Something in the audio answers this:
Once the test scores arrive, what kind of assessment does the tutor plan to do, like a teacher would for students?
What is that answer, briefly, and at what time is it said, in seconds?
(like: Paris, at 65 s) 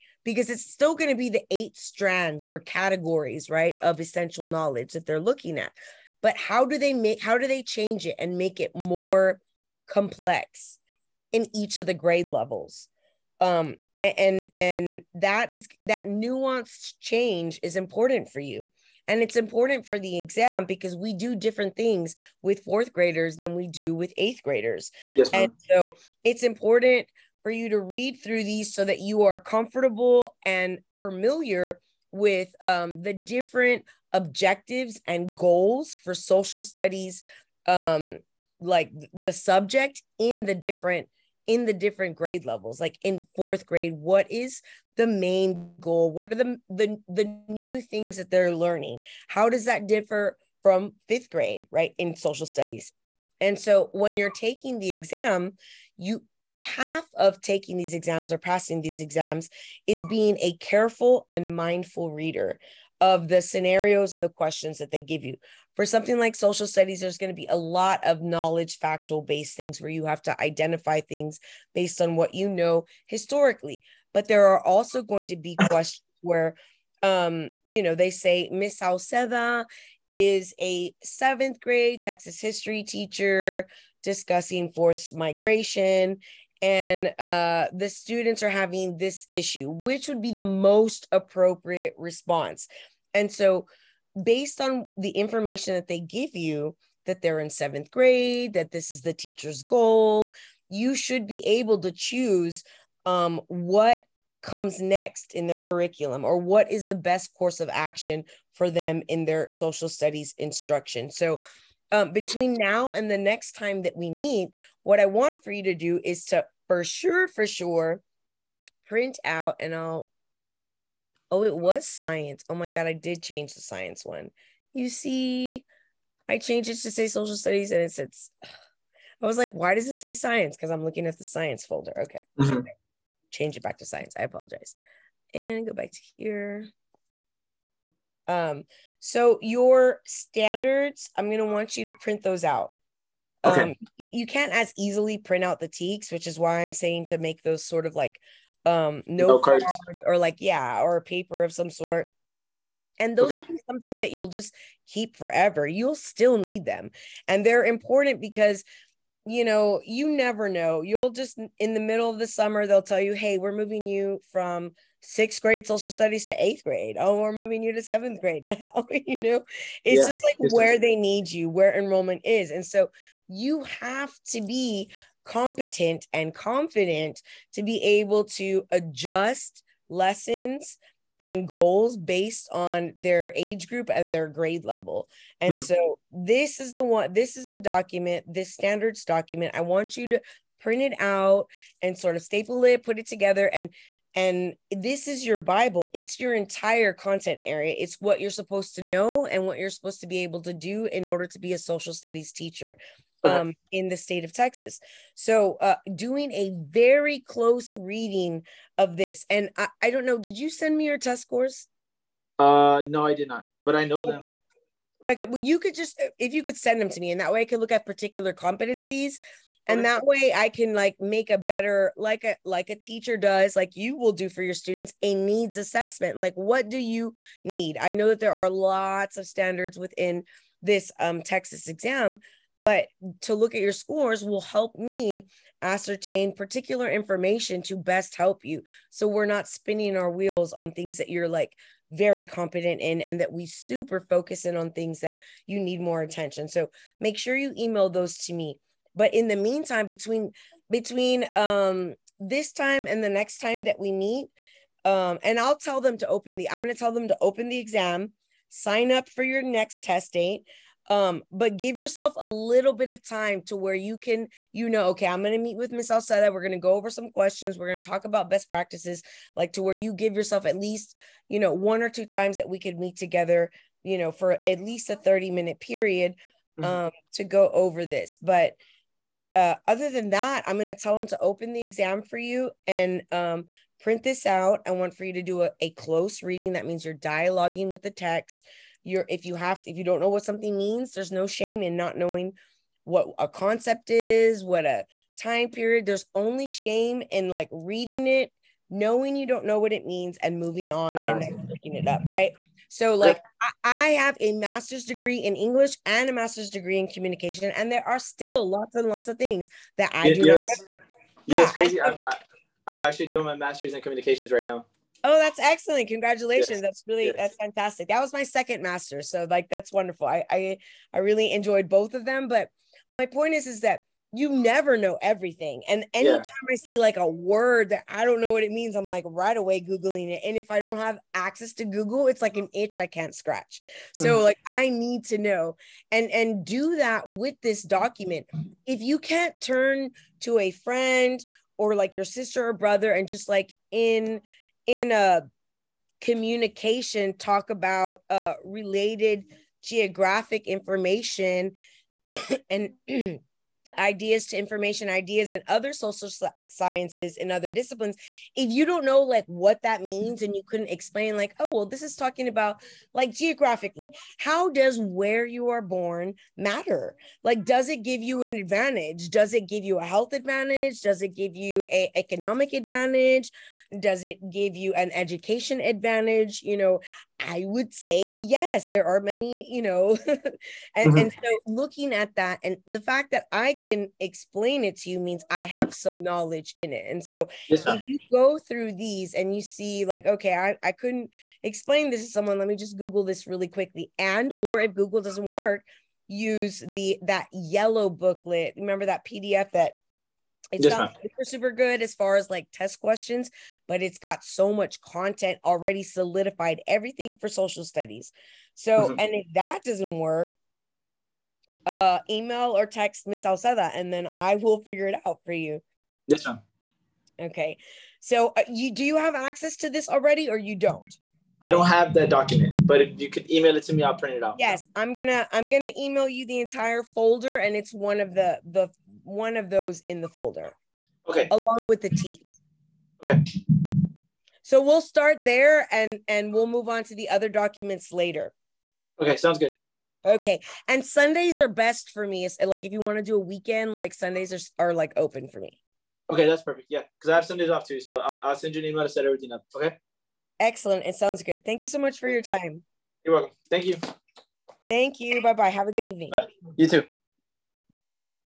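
Needs assessment, at 225 s.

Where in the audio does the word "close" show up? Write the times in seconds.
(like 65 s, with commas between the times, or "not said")
207 s, 285 s.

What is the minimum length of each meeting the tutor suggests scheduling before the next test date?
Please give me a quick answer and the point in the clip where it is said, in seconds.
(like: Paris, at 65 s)
30 minutes, at 274 s.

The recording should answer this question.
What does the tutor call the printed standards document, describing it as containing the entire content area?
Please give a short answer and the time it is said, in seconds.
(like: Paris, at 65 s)
Your bible, at 195 s.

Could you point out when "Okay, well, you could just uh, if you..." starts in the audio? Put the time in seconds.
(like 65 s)
215 s.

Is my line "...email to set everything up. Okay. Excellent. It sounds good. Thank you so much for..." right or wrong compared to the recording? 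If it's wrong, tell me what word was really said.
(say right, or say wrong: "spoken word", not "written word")
right.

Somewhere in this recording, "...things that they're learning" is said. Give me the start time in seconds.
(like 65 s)
47 s.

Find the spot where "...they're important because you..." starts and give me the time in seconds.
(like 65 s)
157 s.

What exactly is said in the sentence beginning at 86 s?
And uh, the students are having this issue, which would be the most appropriate response.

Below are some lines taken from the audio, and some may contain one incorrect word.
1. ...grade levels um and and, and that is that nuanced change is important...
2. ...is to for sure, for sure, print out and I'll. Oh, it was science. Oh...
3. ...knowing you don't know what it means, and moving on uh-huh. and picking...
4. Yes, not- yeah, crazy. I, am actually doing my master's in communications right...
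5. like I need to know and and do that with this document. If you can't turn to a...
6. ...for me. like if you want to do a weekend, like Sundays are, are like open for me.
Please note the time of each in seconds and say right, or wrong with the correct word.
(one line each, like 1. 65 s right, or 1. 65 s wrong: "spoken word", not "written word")
1. 11 s right
2. 116 s right
3. 298 s right
4. 310 s right
5. 334 s right
6. 441 s right.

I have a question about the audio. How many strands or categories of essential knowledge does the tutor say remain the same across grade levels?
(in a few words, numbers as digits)
8.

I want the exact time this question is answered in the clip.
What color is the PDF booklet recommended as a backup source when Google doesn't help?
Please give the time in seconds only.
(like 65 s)
397 s.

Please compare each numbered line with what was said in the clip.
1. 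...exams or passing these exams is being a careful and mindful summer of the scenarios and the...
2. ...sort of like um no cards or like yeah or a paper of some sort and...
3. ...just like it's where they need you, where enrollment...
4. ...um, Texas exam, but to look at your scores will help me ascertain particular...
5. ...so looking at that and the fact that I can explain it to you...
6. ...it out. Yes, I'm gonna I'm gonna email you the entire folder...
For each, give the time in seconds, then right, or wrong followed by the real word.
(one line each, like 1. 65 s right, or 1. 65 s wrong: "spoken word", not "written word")
1. 57 s wrong: "reader", not "summer"
2. 147 s right
3. 170 s right
4. 230 s right
5. 381 s right
6. 424 s right.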